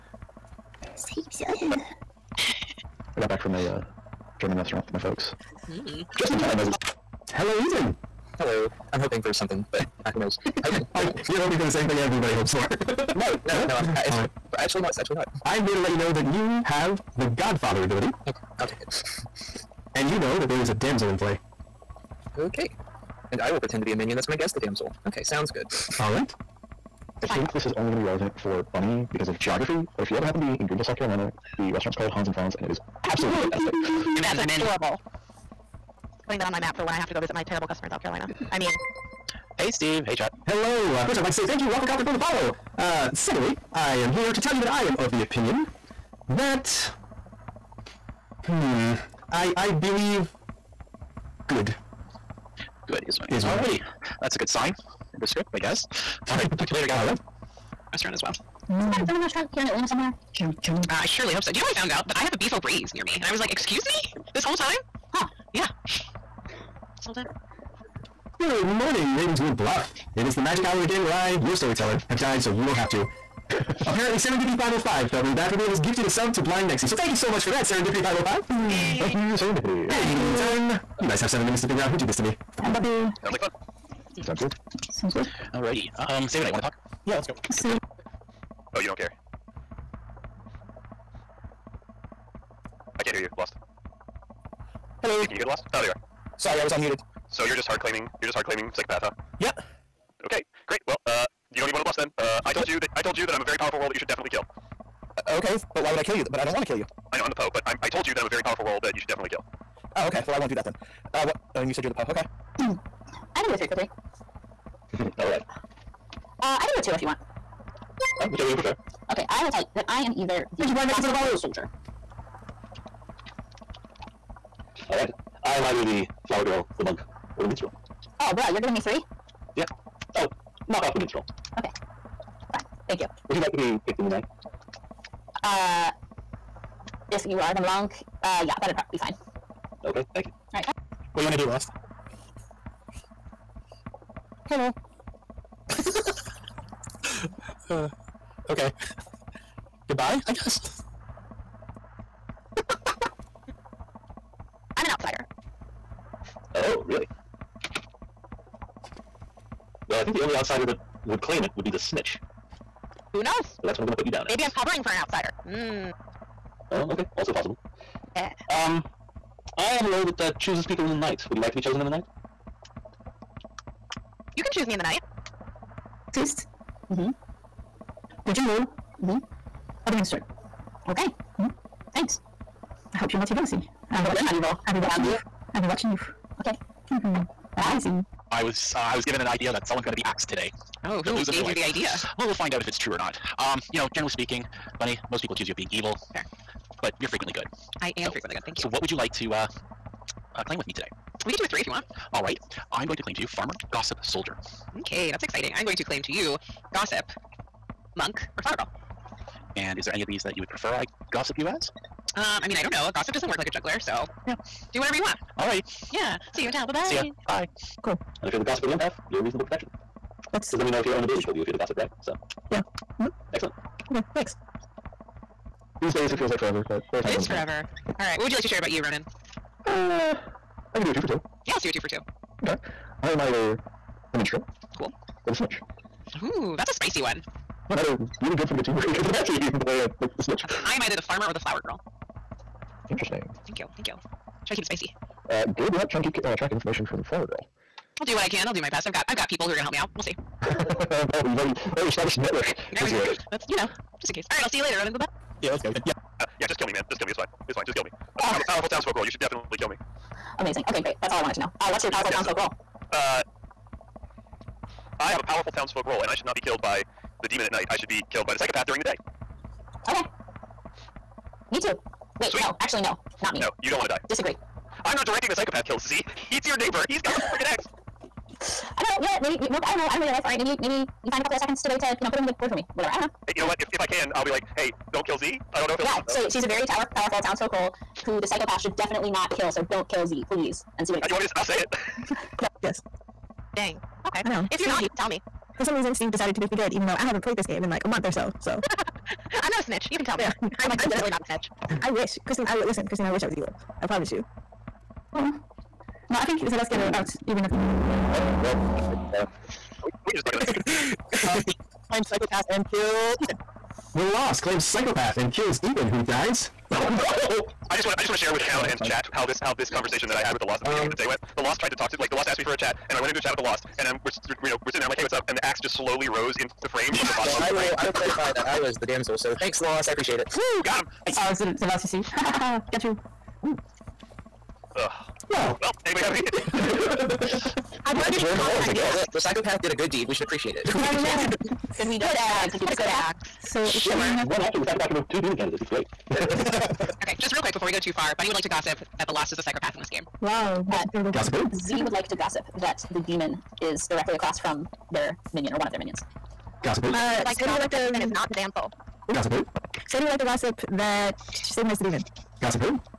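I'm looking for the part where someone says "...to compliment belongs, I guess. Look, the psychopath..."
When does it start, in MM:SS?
05:38.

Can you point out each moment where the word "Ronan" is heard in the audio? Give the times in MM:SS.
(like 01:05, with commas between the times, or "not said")
03:48, 04:14.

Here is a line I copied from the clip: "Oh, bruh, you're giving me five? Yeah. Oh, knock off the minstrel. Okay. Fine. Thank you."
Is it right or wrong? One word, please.
wrong.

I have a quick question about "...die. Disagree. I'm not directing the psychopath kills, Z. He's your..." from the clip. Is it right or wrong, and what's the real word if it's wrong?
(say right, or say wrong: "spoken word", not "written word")
right.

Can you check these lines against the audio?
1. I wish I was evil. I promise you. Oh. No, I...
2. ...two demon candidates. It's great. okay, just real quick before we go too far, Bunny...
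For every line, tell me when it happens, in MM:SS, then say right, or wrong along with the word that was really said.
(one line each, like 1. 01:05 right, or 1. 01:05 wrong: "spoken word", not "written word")
1. 05:03 right
2. 05:45 right.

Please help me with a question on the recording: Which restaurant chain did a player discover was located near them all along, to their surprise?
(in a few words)
Beef O'Brady's.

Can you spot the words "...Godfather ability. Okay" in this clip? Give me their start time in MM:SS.
00:17.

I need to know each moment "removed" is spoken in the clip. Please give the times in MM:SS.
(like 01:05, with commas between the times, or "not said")
05:44.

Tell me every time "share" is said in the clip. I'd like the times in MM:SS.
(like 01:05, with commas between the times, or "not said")
03:48, 05:18.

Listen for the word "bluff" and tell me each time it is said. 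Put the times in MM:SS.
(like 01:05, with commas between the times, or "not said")
01:09, 01:41.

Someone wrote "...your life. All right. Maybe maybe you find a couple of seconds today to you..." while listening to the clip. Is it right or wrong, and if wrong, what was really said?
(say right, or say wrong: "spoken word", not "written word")
right.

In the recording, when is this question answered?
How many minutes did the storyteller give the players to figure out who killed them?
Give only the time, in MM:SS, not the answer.
01:21.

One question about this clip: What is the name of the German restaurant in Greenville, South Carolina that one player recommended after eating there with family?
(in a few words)
Hans and Franz.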